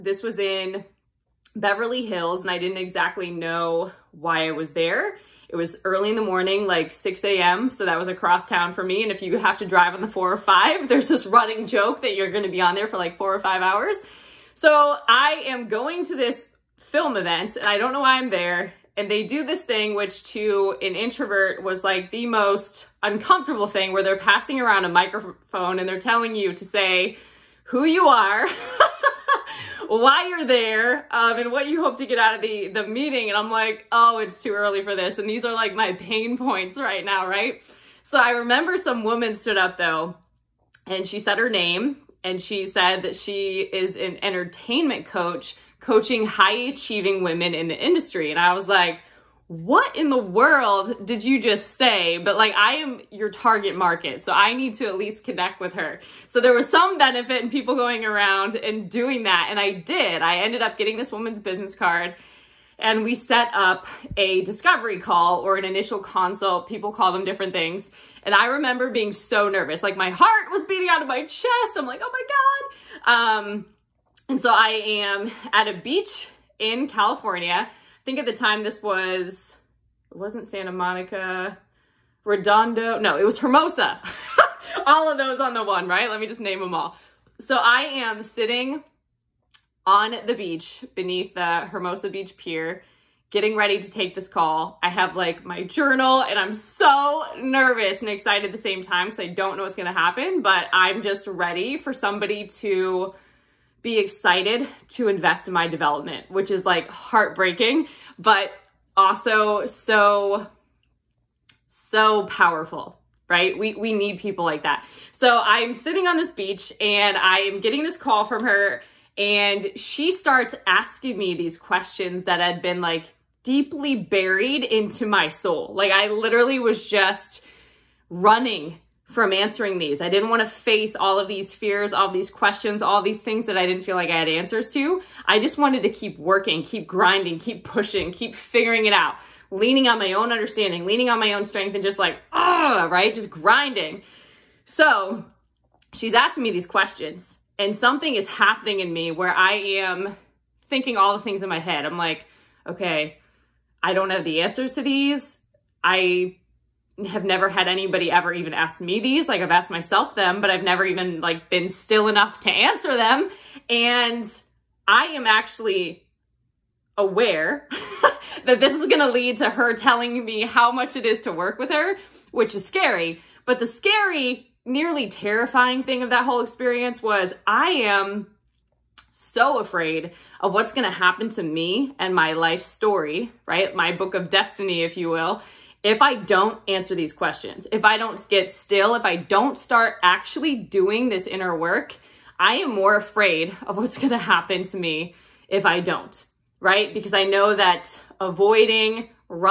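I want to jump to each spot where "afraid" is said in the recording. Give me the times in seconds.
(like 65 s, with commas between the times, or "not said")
179 s, 192 s.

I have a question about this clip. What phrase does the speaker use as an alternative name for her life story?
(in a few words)
book of destiny.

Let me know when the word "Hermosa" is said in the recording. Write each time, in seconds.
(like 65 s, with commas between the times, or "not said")
83 s, 91 s.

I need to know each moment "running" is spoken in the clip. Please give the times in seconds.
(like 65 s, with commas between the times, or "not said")
11 s, 128 s.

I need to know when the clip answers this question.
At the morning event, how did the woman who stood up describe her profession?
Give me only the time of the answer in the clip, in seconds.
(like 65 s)
44 s.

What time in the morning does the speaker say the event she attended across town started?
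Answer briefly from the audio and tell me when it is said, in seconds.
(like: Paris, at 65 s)
6 a.m., at 6 s.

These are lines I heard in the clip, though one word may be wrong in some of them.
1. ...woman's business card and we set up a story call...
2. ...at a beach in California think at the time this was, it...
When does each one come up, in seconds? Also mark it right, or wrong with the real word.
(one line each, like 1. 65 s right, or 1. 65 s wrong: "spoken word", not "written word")
1. 61 s wrong: "discovery", not "story"
2. 75 s right.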